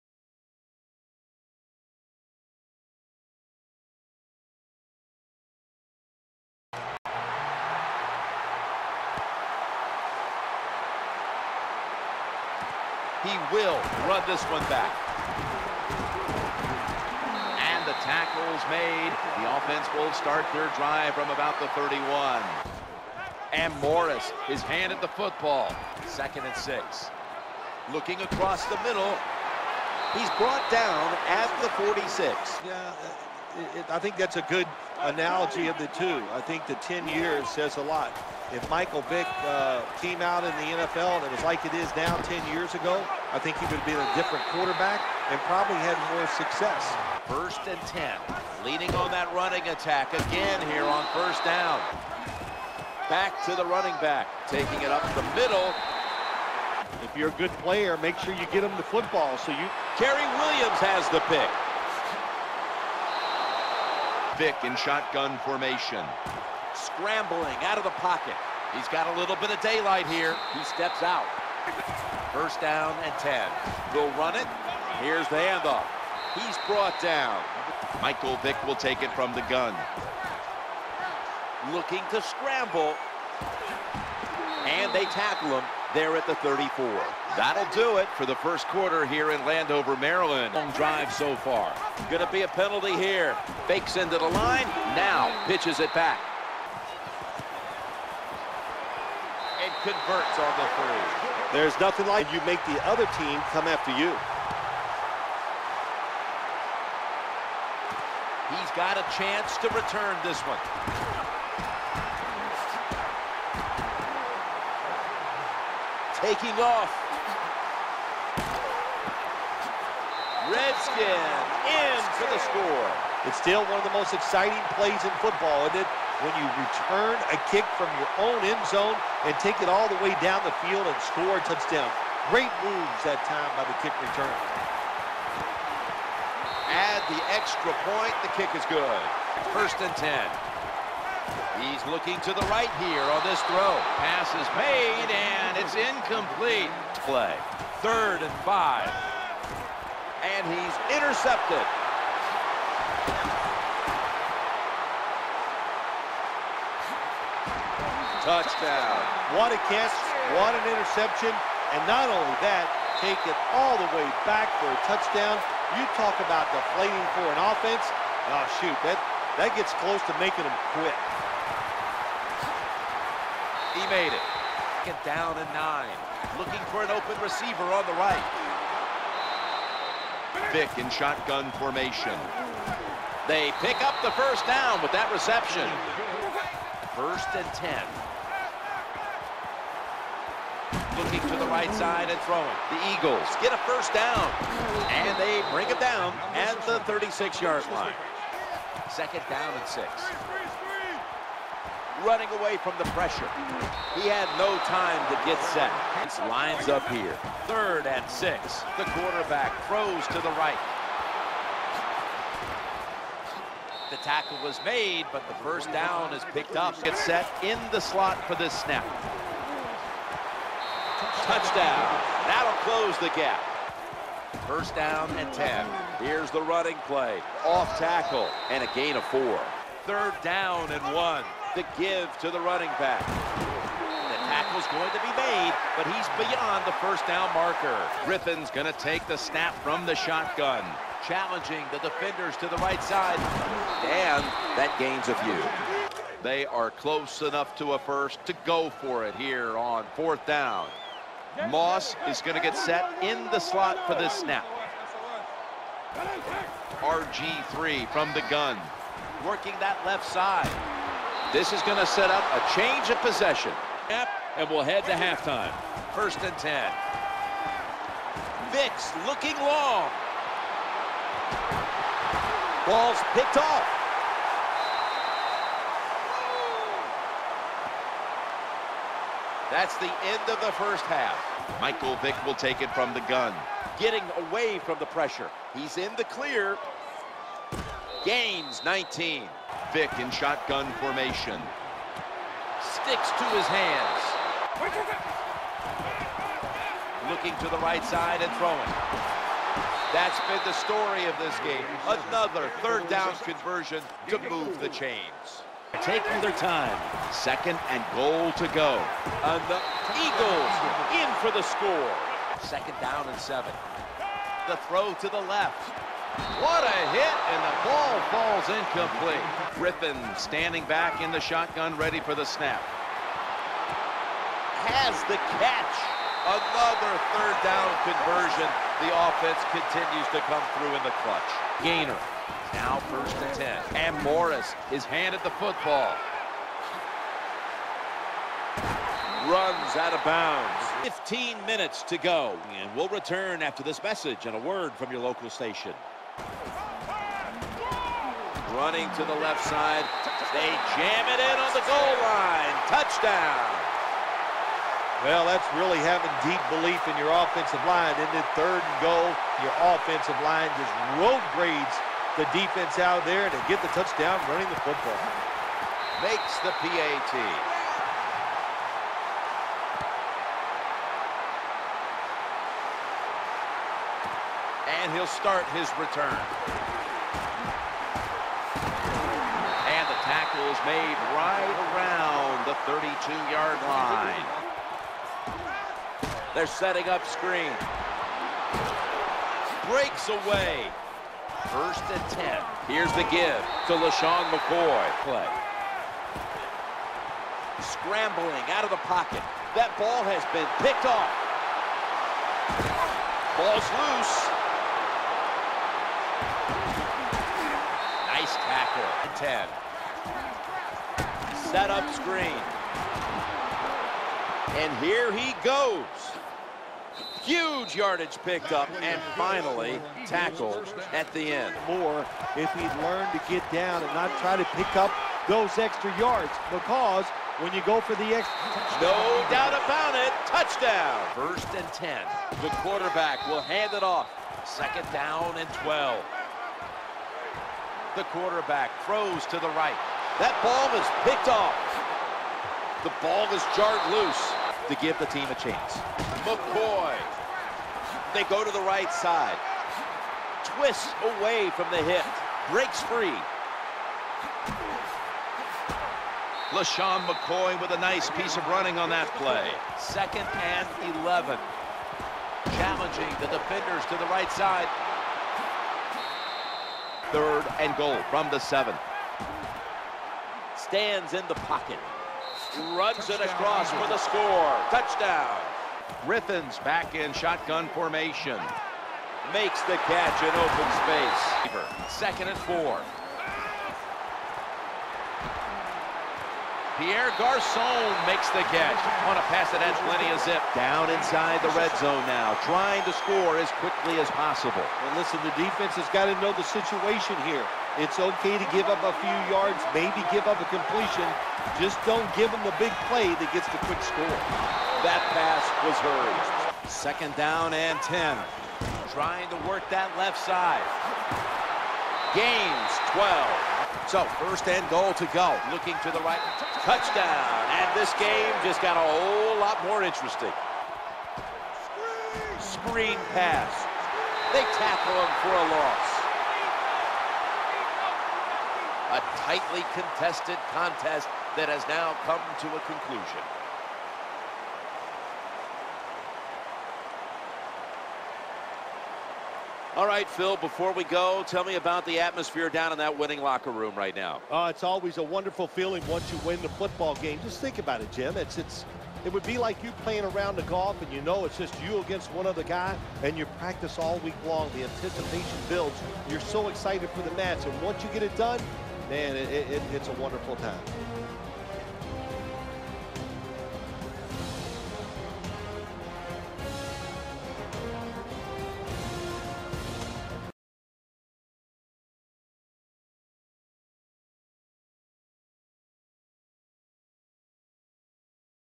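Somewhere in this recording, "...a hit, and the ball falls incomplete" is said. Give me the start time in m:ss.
5:16.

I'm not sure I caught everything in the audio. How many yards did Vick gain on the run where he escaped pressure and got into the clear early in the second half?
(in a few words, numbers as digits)
19.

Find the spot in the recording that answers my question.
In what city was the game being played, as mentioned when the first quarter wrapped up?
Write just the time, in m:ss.
1:29.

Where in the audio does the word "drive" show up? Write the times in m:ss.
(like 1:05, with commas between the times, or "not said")
0:20, 1:30.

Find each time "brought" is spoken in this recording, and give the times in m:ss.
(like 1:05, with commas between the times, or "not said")
0:30, 1:16.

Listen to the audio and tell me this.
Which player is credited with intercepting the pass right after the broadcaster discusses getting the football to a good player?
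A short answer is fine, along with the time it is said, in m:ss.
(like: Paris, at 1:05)
Kerry Williams, at 0:59.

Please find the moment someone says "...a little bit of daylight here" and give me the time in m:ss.
1:09.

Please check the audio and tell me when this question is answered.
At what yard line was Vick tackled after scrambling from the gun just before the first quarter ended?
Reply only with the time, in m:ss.
1:26.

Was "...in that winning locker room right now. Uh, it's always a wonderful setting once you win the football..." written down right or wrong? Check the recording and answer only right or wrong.
wrong.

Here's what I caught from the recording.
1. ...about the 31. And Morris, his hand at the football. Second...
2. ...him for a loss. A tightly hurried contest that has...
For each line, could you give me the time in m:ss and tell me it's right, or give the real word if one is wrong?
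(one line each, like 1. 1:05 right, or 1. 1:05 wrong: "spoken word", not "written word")
1. 0:21 right
2. 8:44 wrong: "contested", not "hurried".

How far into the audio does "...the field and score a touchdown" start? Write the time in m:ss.
2:10.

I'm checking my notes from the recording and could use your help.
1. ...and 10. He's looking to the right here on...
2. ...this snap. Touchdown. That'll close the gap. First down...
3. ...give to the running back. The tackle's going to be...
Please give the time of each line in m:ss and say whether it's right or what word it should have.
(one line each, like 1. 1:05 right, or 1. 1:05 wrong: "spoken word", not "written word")
1. 2:19 right
2. 3:38 right
3. 3:51 right.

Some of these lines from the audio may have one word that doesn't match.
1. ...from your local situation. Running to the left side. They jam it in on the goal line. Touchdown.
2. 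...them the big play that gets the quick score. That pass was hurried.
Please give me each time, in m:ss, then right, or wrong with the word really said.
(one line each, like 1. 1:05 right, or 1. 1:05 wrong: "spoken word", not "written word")
1. 5:44 wrong: "station", not "situation"
2. 8:22 right.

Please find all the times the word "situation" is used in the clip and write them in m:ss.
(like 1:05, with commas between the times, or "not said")
8:16.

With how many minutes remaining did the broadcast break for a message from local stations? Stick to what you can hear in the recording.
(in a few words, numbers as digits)
15.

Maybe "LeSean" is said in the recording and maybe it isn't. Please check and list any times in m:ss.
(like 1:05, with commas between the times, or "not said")
6:33, 7:36.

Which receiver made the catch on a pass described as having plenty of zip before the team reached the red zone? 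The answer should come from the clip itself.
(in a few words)
Pierre Garcon.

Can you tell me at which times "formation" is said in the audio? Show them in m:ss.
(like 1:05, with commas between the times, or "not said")
1:05, 3:01, 4:50, 7:57.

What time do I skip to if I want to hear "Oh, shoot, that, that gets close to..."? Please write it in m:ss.
2:48.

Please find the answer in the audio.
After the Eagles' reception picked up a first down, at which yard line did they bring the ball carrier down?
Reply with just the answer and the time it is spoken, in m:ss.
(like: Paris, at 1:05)
36, at 3:16.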